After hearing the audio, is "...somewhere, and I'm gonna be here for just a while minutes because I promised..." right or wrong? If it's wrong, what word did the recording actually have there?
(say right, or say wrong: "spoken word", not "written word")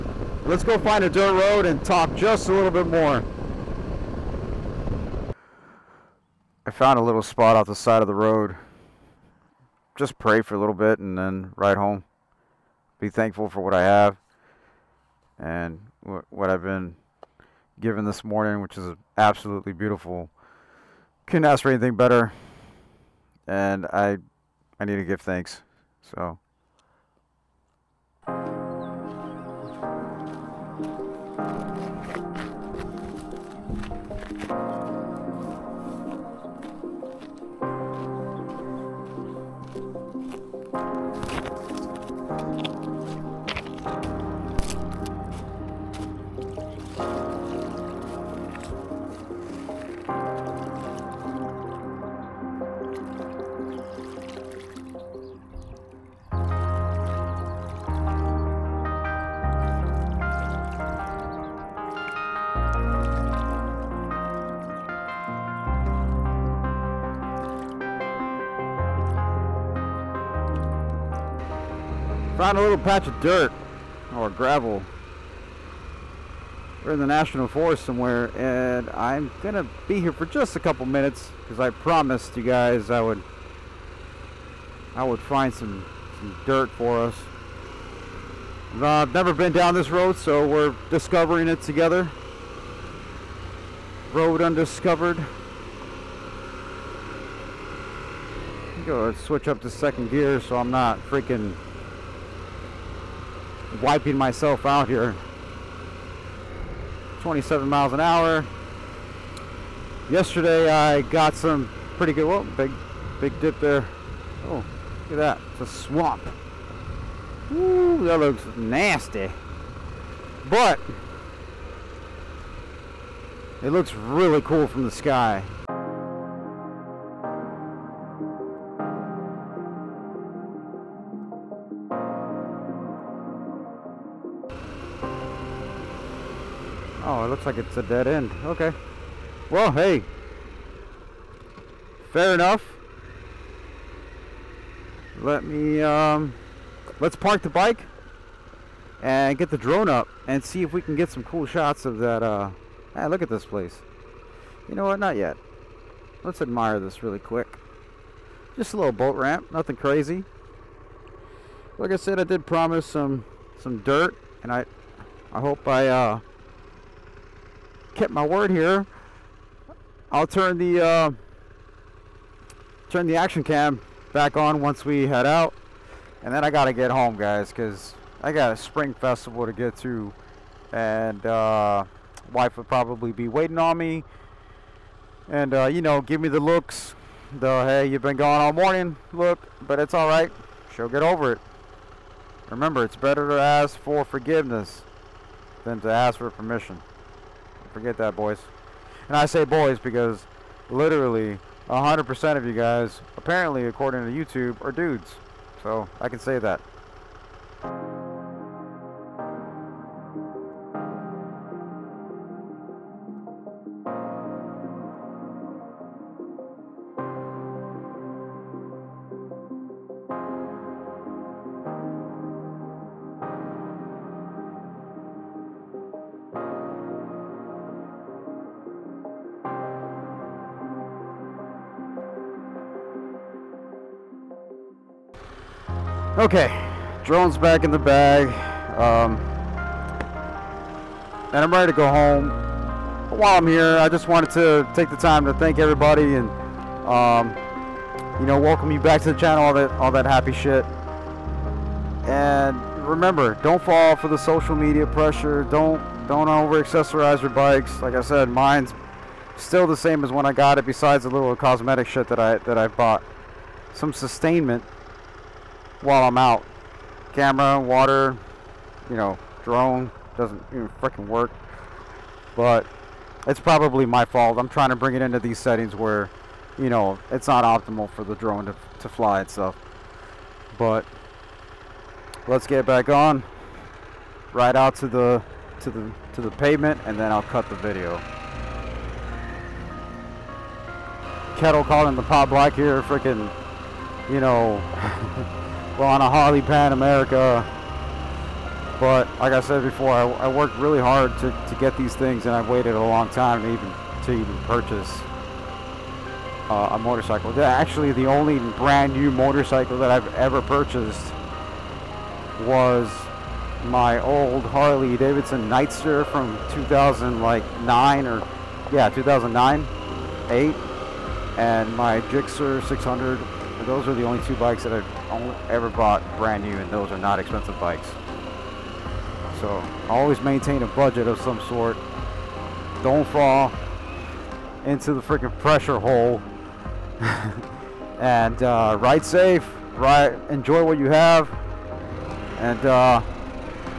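wrong: "couple", not "while".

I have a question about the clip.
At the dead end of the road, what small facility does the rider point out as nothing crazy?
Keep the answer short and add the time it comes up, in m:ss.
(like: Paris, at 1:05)
Boat ramp, at 2:38.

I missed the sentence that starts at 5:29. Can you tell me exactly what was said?
So always maintain a budget of some sort.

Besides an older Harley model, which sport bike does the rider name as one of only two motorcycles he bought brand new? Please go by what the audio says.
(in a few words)
Gixxer 600.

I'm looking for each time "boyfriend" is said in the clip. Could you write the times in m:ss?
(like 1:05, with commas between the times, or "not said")
not said.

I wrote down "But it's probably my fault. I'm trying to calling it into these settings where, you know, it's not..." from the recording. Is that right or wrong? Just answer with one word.
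wrong.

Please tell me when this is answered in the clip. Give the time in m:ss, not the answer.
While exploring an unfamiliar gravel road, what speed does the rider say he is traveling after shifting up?
1:47.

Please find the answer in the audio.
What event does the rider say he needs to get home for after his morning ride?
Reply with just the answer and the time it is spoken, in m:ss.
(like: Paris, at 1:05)
Spring festival, at 2:58.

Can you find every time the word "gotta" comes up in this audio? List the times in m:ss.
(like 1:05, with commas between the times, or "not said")
2:56.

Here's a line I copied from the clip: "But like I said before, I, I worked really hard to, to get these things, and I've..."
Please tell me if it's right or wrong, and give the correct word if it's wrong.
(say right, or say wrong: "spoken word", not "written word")
right.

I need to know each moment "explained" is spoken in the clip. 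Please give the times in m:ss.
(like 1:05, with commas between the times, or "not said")
not said.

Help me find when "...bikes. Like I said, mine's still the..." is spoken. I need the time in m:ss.
4:17.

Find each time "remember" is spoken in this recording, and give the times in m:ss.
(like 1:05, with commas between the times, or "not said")
3:12, 4:12.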